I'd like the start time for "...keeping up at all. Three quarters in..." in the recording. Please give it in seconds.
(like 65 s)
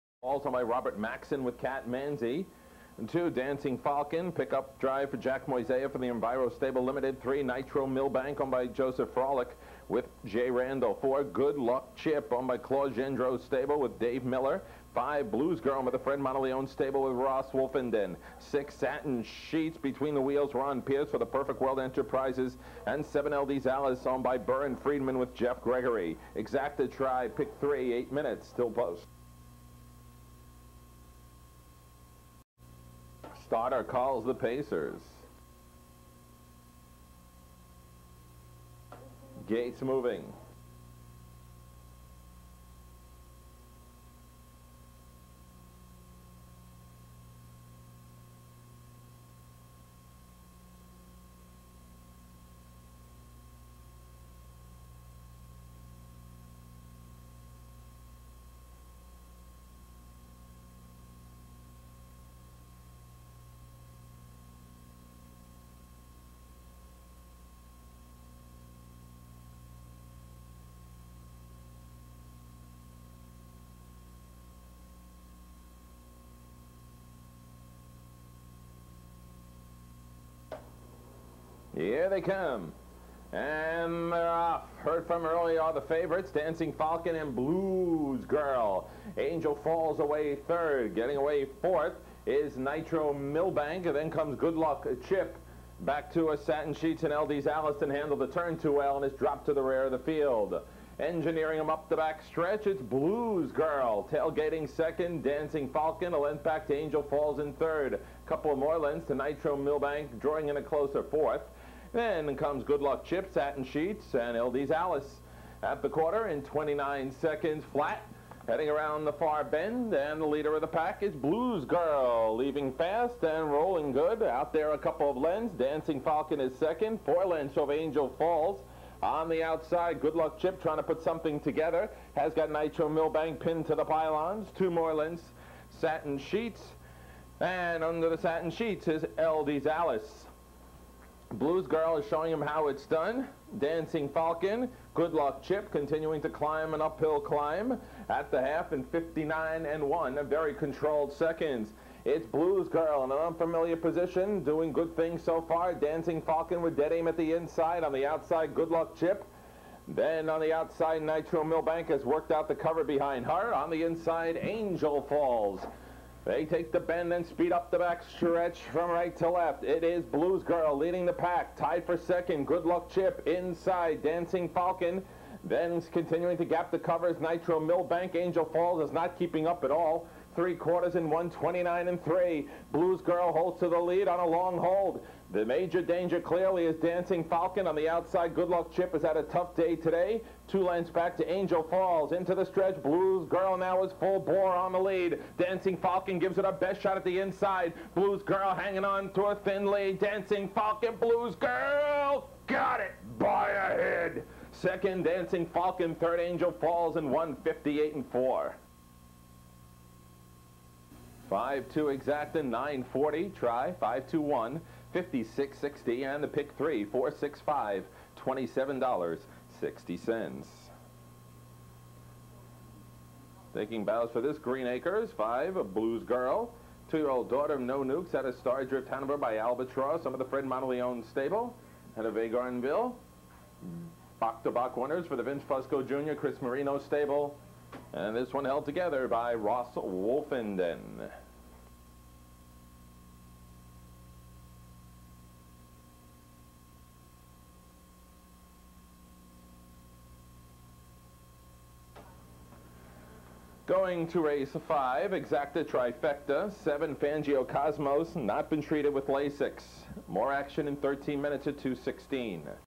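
179 s.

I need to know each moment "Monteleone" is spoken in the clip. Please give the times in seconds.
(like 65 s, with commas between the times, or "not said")
16 s, 230 s.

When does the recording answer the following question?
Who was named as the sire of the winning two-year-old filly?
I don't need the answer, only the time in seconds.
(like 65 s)
227 s.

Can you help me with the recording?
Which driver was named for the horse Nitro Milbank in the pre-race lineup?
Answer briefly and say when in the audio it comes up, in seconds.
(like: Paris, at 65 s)
Jay Randall, at 10 s.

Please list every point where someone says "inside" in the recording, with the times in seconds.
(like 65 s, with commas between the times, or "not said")
157 s, 163 s, 173 s, 197 s.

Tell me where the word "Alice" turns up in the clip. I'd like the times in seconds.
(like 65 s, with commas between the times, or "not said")
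23 s, 114 s, 139 s.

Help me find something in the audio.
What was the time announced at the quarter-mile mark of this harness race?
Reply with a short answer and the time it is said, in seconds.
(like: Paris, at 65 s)
29 seconds flat, at 116 s.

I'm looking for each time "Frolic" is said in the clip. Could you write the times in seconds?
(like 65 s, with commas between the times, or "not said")
9 s.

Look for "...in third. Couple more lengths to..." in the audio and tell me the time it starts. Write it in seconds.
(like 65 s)
107 s.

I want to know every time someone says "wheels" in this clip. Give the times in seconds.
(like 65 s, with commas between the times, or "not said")
20 s.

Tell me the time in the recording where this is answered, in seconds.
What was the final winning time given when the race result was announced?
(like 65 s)
207 s.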